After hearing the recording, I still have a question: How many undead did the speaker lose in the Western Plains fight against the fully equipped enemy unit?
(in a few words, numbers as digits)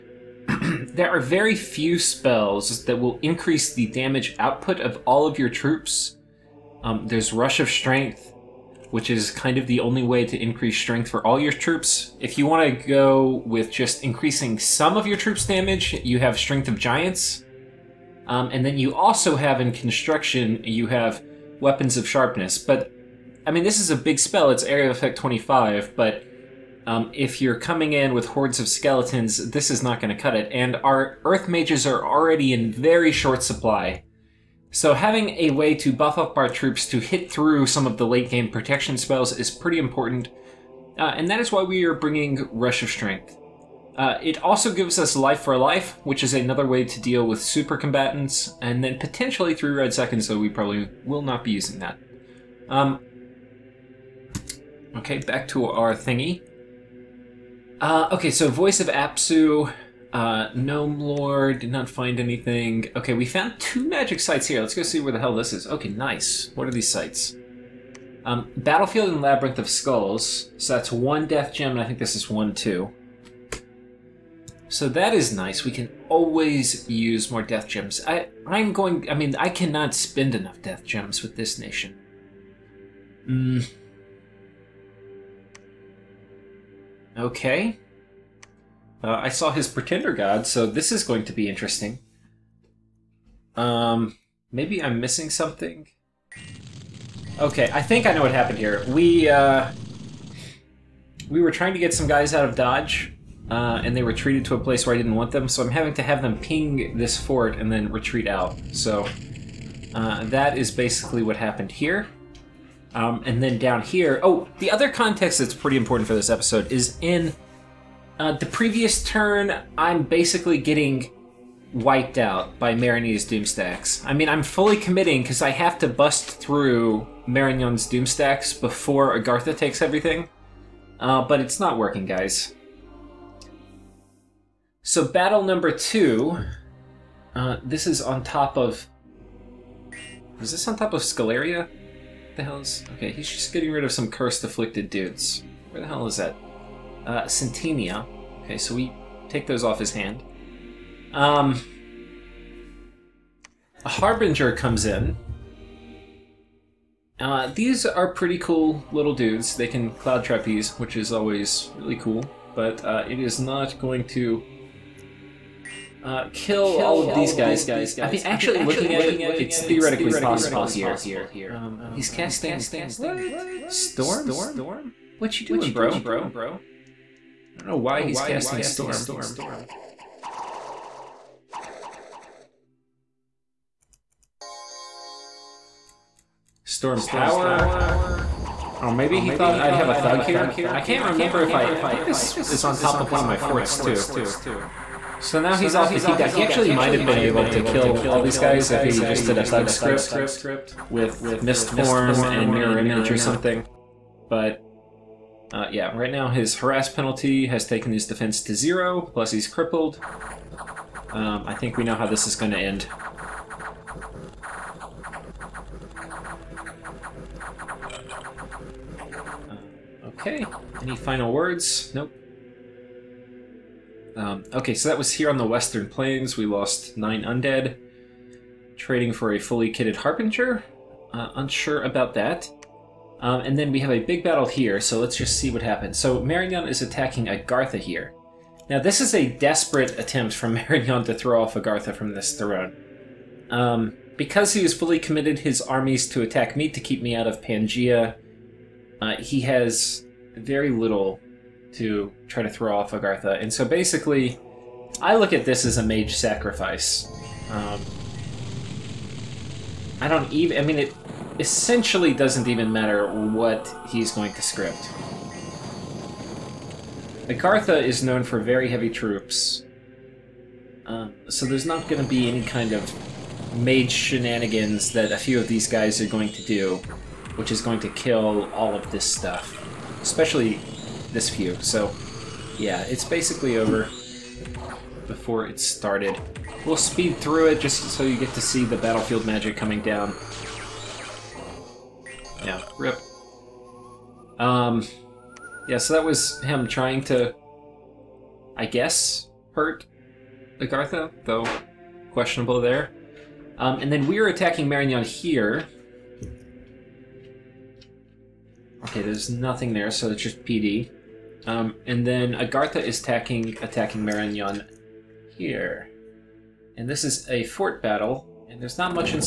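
9.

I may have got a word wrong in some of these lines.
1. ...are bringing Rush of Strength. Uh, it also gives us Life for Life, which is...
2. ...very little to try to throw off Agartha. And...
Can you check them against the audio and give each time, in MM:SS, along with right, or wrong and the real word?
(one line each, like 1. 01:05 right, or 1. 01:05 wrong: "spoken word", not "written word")
1. 00:41 right
2. 04:10 right.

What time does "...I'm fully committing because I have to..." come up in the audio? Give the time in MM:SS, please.
02:04.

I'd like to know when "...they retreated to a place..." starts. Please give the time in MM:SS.
01:43.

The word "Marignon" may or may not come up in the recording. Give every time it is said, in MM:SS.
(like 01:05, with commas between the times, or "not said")
03:56, 04:00, 05:04, 05:14.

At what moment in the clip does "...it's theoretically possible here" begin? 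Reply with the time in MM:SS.
02:49.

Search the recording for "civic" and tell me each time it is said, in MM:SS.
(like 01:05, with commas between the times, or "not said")
not said.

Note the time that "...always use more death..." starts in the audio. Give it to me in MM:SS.
01:16.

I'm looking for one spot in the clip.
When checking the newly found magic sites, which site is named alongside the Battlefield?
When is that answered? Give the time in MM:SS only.
01:09.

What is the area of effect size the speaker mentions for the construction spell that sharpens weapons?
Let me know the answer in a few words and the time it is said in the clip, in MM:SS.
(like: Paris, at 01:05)
25, at 00:24.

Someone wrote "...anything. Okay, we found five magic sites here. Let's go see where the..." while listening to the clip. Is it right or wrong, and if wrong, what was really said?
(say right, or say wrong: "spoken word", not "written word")
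wrong: "two", not "five".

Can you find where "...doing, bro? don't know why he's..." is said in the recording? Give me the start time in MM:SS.
02:55.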